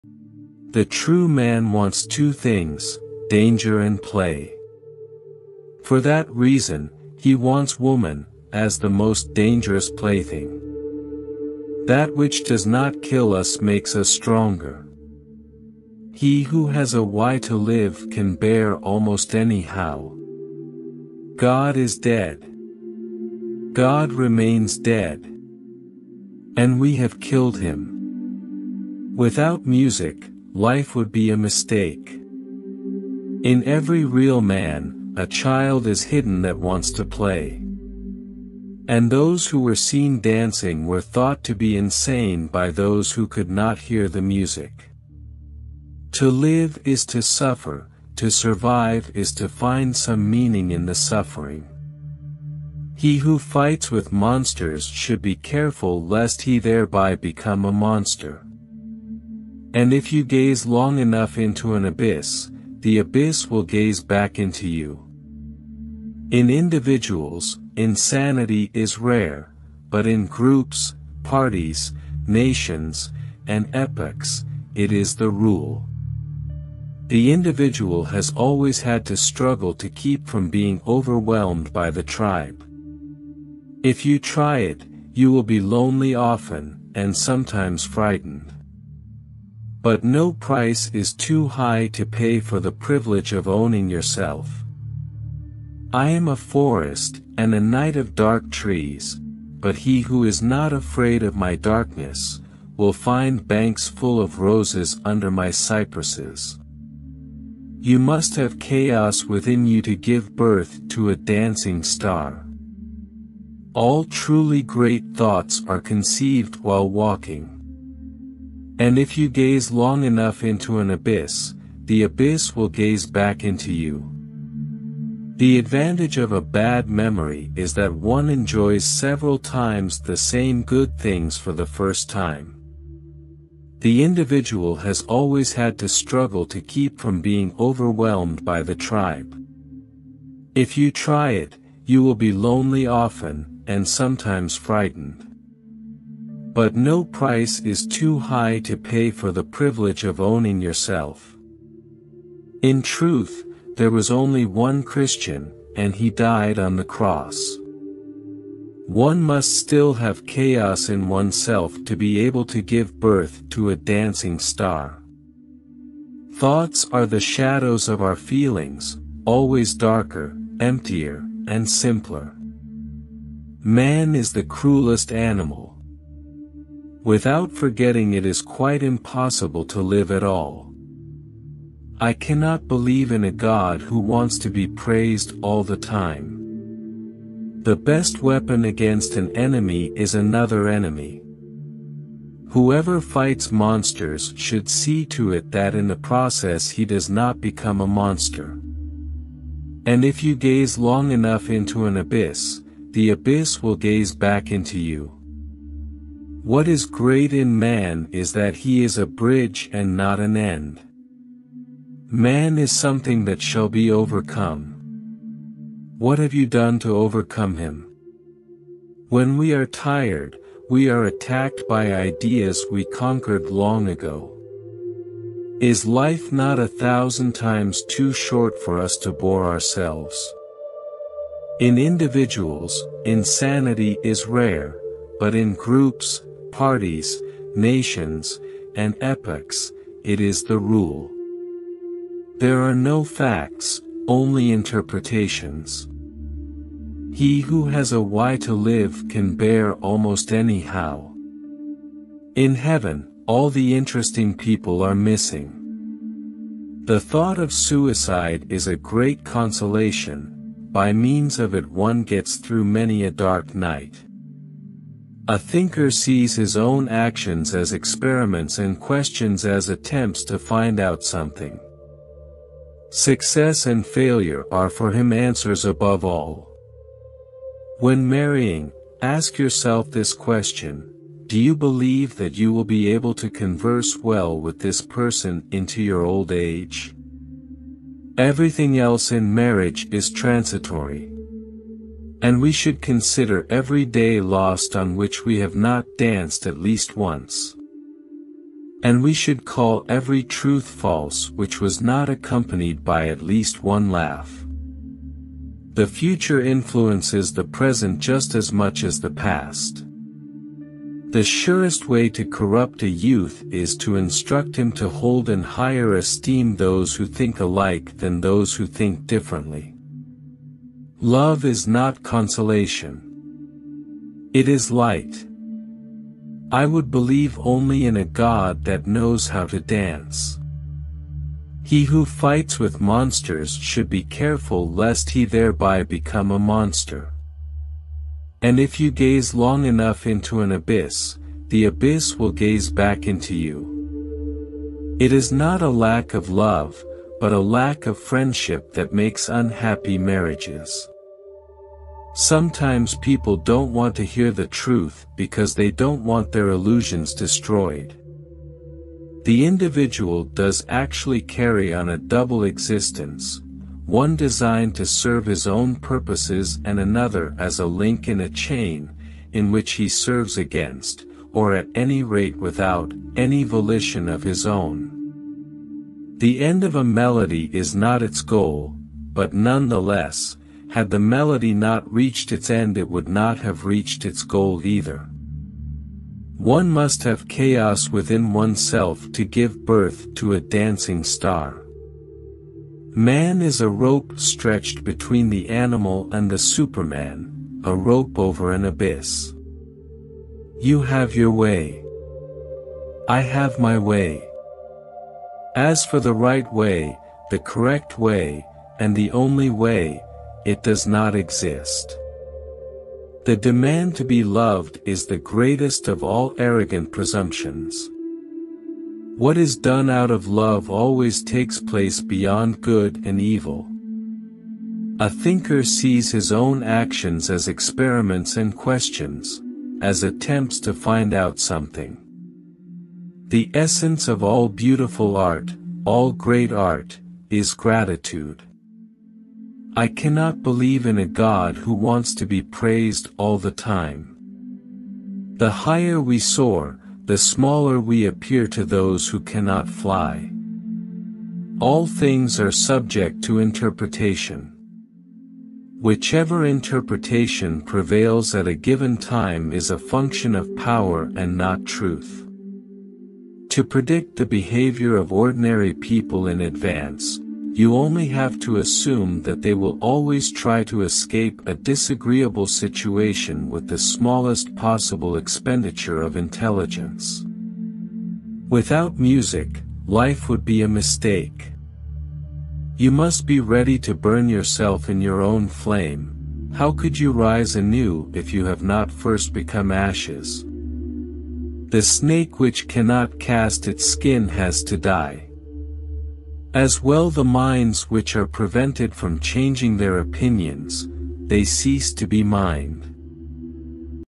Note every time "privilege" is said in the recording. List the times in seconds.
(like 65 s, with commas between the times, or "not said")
92 s, 149 s.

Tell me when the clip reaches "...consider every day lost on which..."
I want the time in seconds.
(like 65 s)
292 s.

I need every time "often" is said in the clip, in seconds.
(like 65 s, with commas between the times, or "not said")
86 s, 142 s.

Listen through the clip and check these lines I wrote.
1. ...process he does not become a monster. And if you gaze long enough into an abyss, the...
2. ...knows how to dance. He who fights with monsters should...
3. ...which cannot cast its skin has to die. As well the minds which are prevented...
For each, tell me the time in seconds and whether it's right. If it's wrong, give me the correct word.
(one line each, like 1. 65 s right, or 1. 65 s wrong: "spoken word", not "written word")
1. 195 s right
2. 328 s right
3. 492 s right.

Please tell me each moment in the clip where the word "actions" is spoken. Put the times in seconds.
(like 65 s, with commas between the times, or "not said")
266 s, 426 s.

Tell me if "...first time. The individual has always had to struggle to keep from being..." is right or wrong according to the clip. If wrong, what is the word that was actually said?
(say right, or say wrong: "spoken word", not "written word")
right.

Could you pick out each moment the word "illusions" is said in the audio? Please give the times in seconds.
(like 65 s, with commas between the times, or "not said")
356 s.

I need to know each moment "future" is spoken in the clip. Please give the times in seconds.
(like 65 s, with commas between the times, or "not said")
305 s.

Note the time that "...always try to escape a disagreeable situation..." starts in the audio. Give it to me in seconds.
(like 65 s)
469 s.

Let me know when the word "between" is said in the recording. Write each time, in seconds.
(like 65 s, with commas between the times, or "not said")
394 s.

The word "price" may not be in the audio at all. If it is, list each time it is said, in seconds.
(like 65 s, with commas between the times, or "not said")
90 s, 147 s.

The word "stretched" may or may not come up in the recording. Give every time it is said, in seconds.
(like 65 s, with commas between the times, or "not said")
394 s.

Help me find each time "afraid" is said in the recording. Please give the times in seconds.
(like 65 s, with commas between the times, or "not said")
100 s.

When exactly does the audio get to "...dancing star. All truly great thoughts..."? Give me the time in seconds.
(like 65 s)
111 s.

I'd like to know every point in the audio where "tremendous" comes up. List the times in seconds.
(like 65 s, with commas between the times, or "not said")
not said.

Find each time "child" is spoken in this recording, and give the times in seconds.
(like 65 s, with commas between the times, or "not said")
35 s.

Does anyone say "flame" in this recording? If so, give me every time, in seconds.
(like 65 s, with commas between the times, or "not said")
485 s.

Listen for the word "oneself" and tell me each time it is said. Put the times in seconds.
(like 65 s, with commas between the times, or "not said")
161 s, 388 s.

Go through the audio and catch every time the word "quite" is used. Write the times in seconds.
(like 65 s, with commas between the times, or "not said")
178 s.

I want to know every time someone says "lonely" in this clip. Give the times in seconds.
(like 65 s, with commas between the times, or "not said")
85 s, 142 s.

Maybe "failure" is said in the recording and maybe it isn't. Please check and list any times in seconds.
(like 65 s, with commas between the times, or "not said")
273 s.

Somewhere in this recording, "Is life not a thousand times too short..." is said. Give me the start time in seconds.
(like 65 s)
225 s.